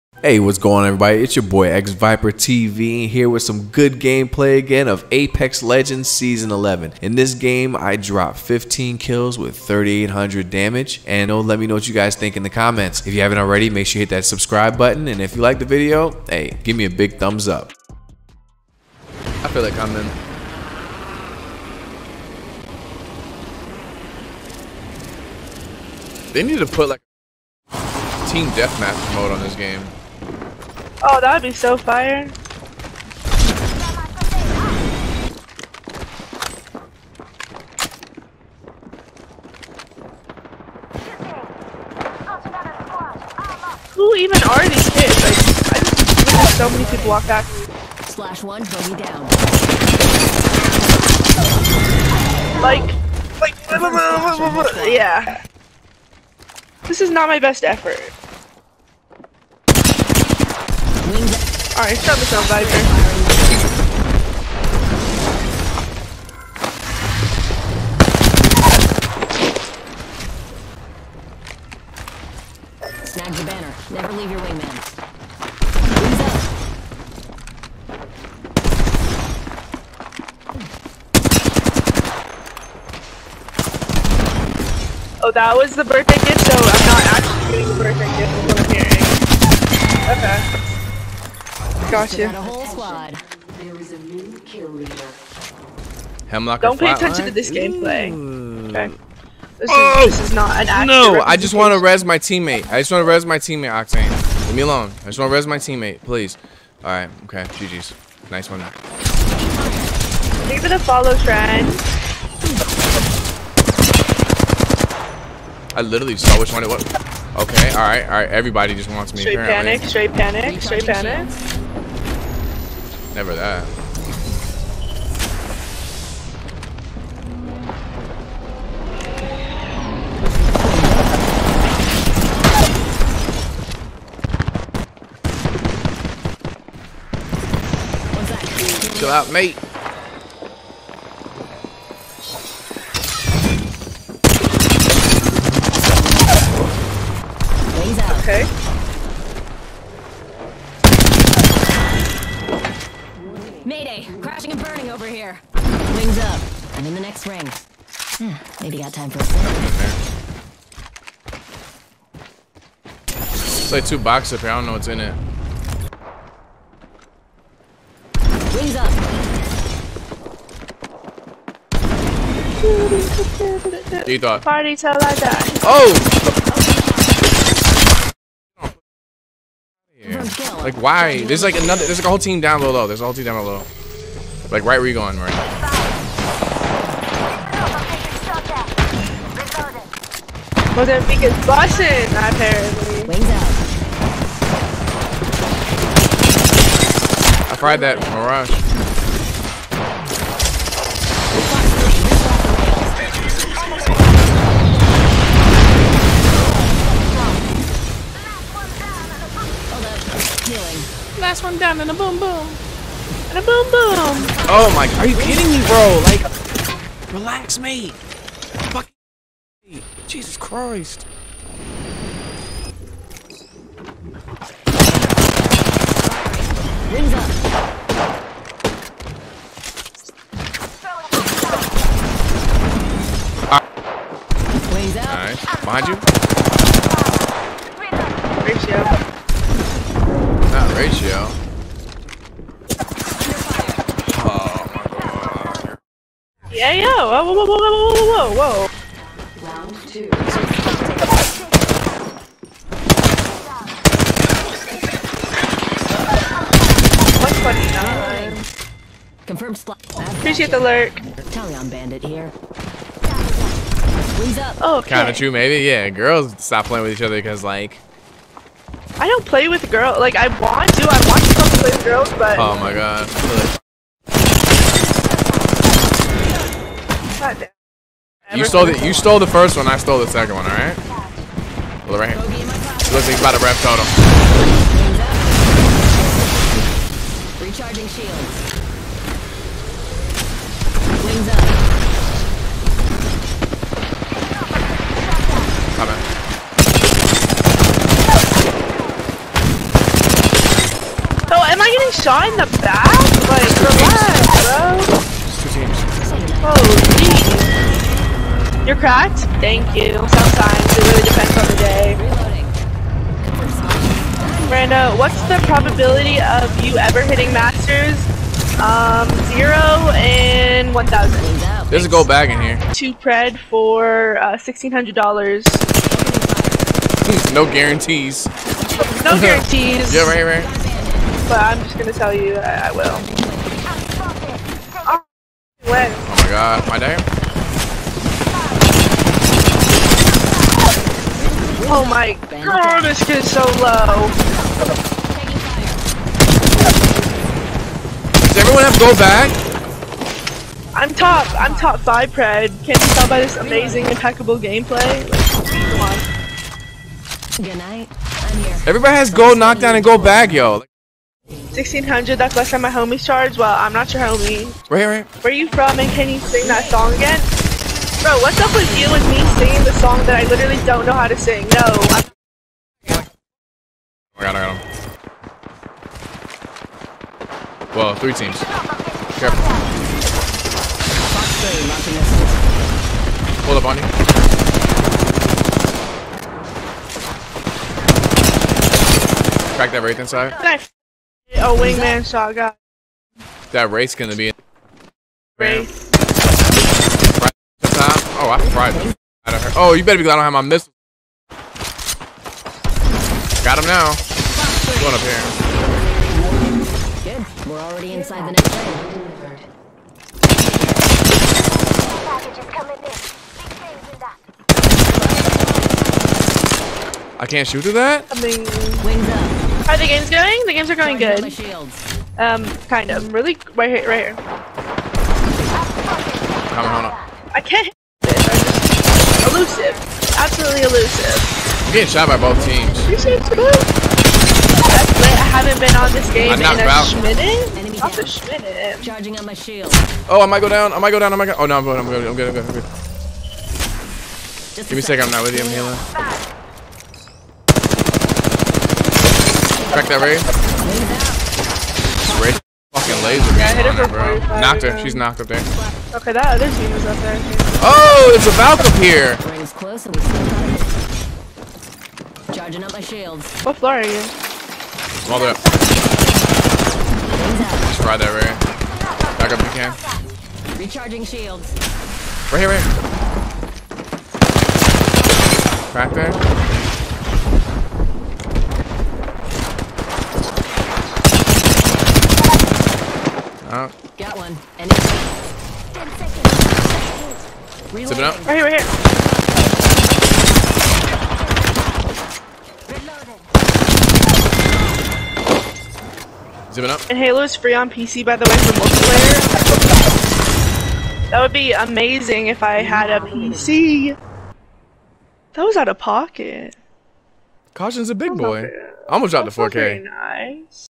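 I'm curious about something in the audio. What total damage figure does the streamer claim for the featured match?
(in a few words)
3800.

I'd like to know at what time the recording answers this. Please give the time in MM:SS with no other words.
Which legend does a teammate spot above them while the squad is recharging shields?
07:38.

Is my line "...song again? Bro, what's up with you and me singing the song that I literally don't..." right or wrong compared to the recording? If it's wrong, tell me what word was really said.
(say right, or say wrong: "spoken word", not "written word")
right.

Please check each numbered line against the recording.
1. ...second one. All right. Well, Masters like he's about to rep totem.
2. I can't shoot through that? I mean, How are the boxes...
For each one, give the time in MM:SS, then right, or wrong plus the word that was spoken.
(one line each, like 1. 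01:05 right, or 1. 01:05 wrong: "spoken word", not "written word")
1. 04:40 wrong: "Looks", not "Masters"
2. 06:57 wrong: "games", not "boxes".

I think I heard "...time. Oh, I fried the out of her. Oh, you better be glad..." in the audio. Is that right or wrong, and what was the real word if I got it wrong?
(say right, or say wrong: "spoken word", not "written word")
right.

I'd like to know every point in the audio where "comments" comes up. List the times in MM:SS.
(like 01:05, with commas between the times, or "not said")
00:12.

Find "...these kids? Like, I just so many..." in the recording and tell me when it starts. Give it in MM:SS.
00:44.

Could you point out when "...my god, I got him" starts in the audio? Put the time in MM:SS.
06:14.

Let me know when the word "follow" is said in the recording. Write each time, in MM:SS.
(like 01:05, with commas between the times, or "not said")
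01:50.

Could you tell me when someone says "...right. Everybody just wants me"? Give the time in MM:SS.
01:58.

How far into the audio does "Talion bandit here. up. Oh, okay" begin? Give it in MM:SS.
04:21.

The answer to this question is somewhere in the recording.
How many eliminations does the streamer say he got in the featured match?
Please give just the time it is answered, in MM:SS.
00:08.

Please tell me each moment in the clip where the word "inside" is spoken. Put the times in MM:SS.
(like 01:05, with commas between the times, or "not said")
06:29, 06:47.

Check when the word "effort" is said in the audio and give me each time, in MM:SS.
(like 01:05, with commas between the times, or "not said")
00:57.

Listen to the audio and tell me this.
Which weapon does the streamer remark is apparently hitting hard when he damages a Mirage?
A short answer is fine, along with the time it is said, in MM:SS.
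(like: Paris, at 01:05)
Mozambique, at 03:10.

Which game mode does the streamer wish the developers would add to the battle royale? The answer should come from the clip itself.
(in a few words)
Team deathmatch.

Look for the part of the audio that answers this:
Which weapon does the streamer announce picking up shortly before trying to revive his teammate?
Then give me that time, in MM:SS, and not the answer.
01:36.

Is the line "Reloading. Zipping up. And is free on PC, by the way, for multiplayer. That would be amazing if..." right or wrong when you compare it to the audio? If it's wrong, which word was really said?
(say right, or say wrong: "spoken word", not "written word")
right.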